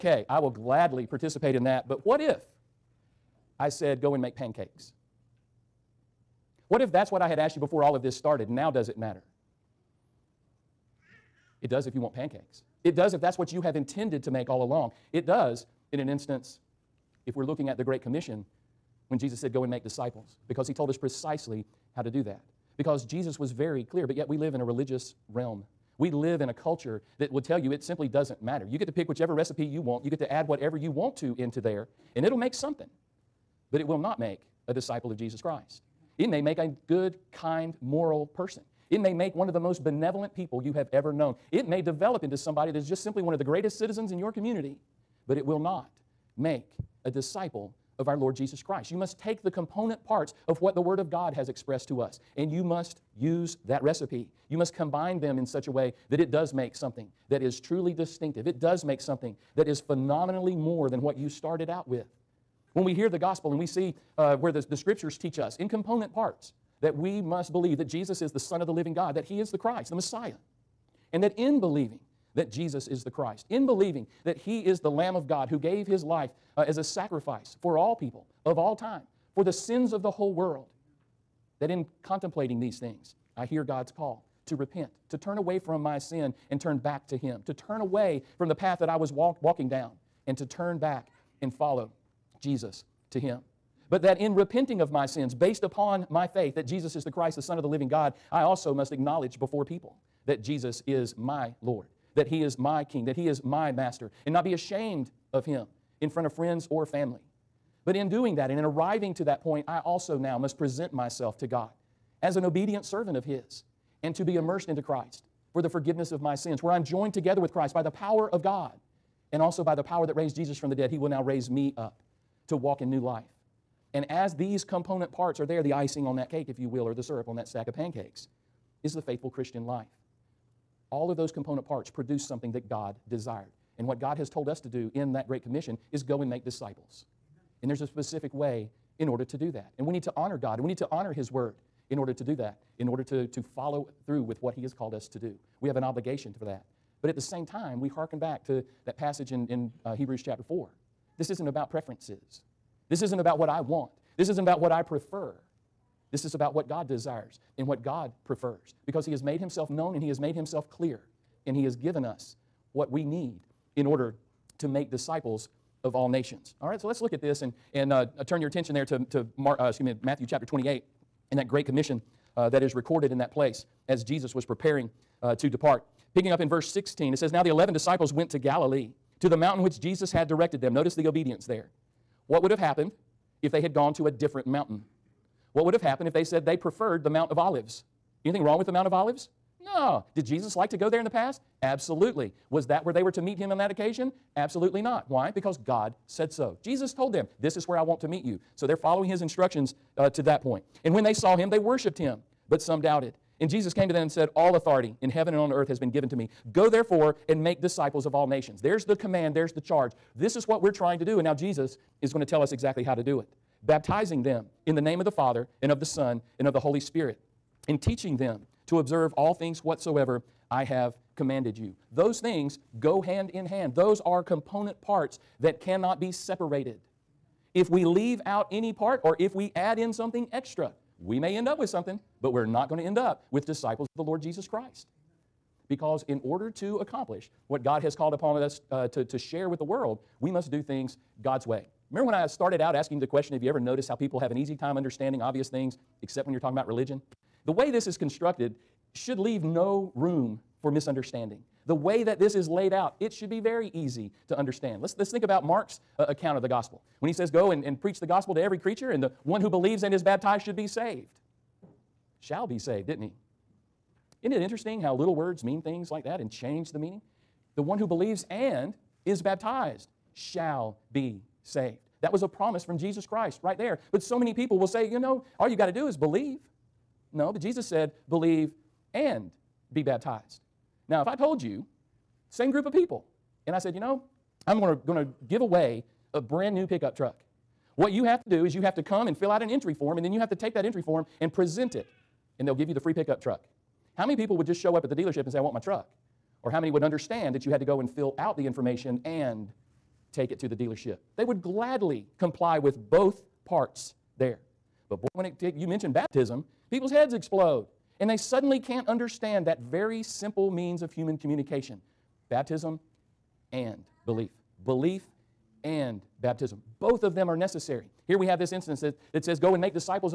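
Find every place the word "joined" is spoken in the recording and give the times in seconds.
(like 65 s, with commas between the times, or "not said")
116 s.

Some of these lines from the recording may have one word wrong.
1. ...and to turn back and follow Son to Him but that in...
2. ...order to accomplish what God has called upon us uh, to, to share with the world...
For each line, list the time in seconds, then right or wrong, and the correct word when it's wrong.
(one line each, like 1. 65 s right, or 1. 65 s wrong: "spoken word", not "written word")
1. 90 s wrong: "Jesus", not "Son"
2. 236 s right.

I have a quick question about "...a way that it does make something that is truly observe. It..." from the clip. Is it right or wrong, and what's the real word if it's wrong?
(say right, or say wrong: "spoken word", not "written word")
wrong: "distinctive", not "observe".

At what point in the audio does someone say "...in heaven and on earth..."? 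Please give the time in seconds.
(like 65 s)
205 s.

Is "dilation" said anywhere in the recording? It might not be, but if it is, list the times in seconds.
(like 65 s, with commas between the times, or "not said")
not said.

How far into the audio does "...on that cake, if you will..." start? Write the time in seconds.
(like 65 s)
126 s.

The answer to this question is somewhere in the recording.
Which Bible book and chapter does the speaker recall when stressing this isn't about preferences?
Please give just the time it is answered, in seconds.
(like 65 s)
149 s.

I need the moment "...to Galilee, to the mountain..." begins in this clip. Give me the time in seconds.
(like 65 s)
178 s.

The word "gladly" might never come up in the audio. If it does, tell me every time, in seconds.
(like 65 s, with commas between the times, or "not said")
0 s, 301 s.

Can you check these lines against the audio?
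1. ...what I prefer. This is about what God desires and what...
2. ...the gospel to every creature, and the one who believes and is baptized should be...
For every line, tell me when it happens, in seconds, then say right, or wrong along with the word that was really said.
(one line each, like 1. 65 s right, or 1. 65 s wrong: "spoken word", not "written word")
1. 154 s right
2. 257 s right.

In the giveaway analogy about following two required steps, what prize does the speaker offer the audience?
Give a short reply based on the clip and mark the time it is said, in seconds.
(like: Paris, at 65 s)
brand new pickup truck, at 286 s.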